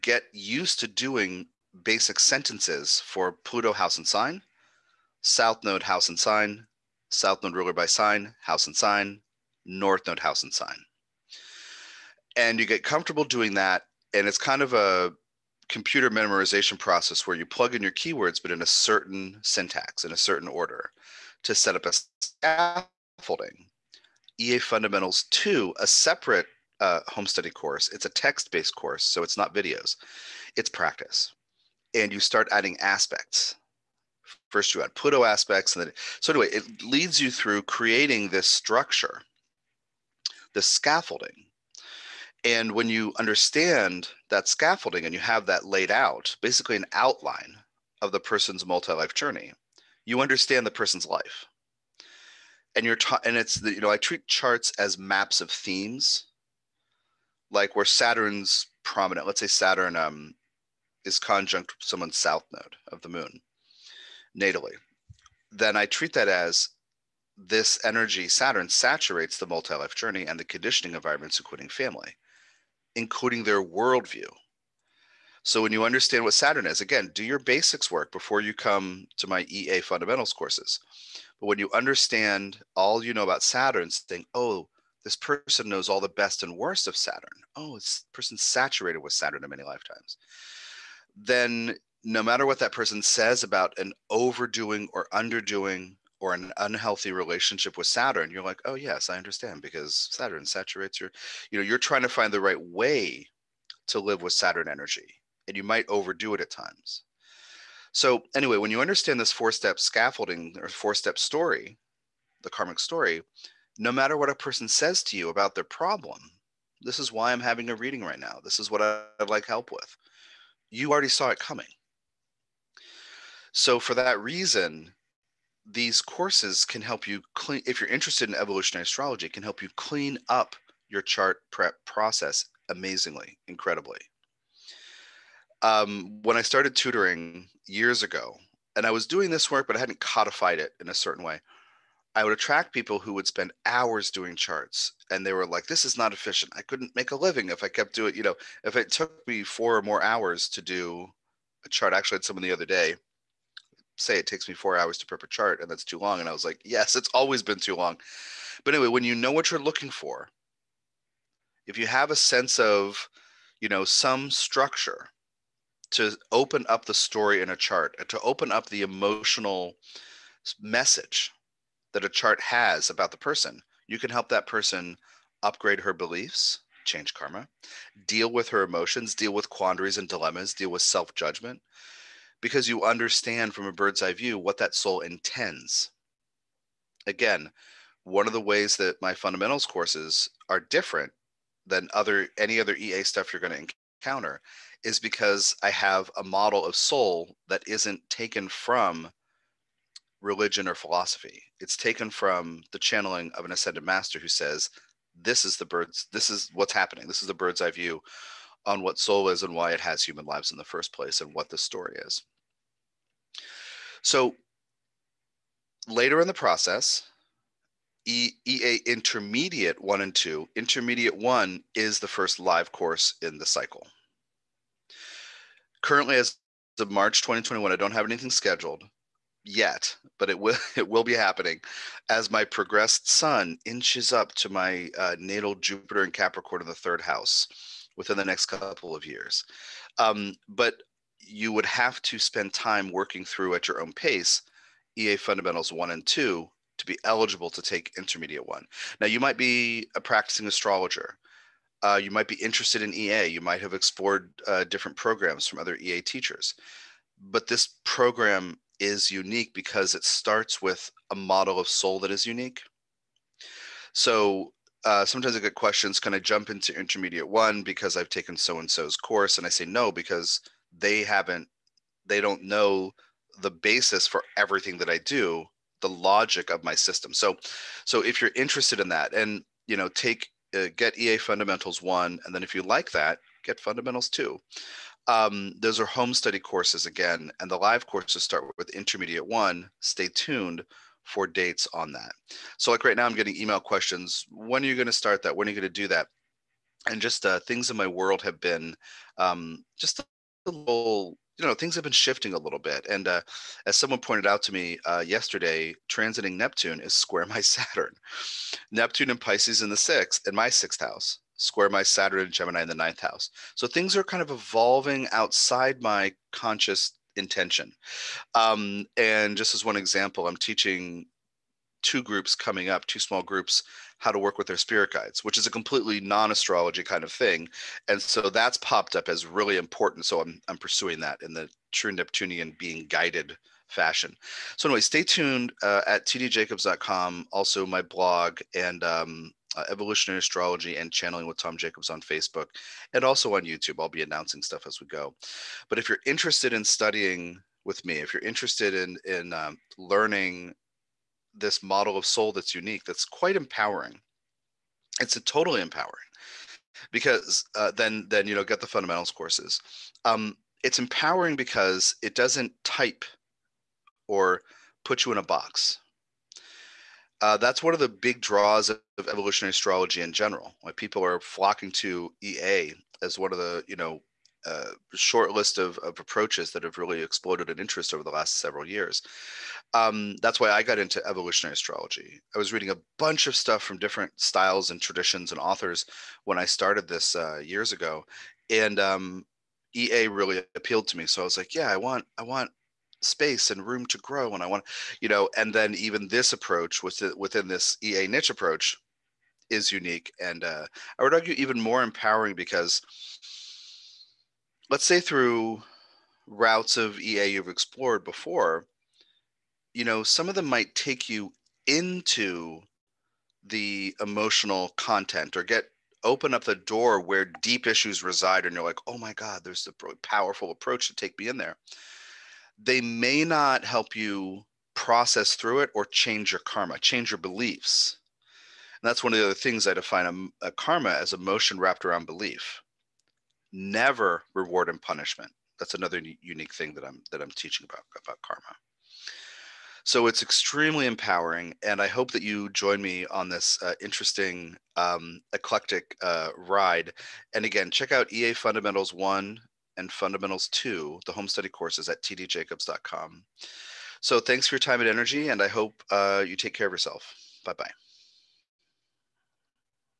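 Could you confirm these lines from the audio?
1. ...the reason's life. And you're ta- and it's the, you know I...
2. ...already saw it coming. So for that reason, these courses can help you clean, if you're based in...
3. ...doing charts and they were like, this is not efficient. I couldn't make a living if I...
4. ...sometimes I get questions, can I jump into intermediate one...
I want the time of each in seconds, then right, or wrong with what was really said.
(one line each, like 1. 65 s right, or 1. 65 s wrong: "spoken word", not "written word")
1. 50 s wrong: "person", not "reason"
2. 120 s wrong: "interested", not "based"
3. 144 s right
4. 265 s right.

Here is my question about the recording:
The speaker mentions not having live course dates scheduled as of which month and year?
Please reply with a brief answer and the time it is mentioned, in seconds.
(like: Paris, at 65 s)
March 2021, at 226 s.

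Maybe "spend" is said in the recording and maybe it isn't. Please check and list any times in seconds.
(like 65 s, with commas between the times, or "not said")
143 s, 242 s.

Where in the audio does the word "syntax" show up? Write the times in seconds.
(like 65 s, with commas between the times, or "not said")
19 s.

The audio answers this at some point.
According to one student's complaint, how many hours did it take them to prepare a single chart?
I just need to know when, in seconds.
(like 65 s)
154 s.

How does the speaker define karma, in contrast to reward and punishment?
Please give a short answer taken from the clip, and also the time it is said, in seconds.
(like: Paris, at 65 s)
emotion wrapped around belief, at 431 s.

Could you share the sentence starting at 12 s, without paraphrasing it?
And you get comfortable doing that.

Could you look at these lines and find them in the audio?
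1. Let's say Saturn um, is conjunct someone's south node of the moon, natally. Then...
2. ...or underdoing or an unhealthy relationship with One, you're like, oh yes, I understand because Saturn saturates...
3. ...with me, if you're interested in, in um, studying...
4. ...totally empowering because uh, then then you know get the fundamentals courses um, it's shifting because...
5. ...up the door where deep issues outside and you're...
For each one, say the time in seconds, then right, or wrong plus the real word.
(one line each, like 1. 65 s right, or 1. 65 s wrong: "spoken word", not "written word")
1. 59 s right
2. 94 s wrong: "Saturn", not "One"
3. 347 s wrong: "learning", not "studying"
4. 355 s wrong: "empowering", not "shifting"
5. 416 s wrong: "reside", not "outside".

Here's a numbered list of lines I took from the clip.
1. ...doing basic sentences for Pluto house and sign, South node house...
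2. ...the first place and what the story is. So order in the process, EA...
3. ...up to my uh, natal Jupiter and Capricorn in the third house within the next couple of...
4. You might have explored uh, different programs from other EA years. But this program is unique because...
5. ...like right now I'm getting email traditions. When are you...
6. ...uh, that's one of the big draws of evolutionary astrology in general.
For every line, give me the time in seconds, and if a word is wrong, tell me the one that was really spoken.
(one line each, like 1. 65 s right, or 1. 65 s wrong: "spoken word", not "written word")
1. 0 s right
2. 210 s wrong: "later", not "order"
3. 234 s right
4. 253 s wrong: "teachers", not "years"
5. 292 s wrong: "questions", not "traditions"
6. 367 s right.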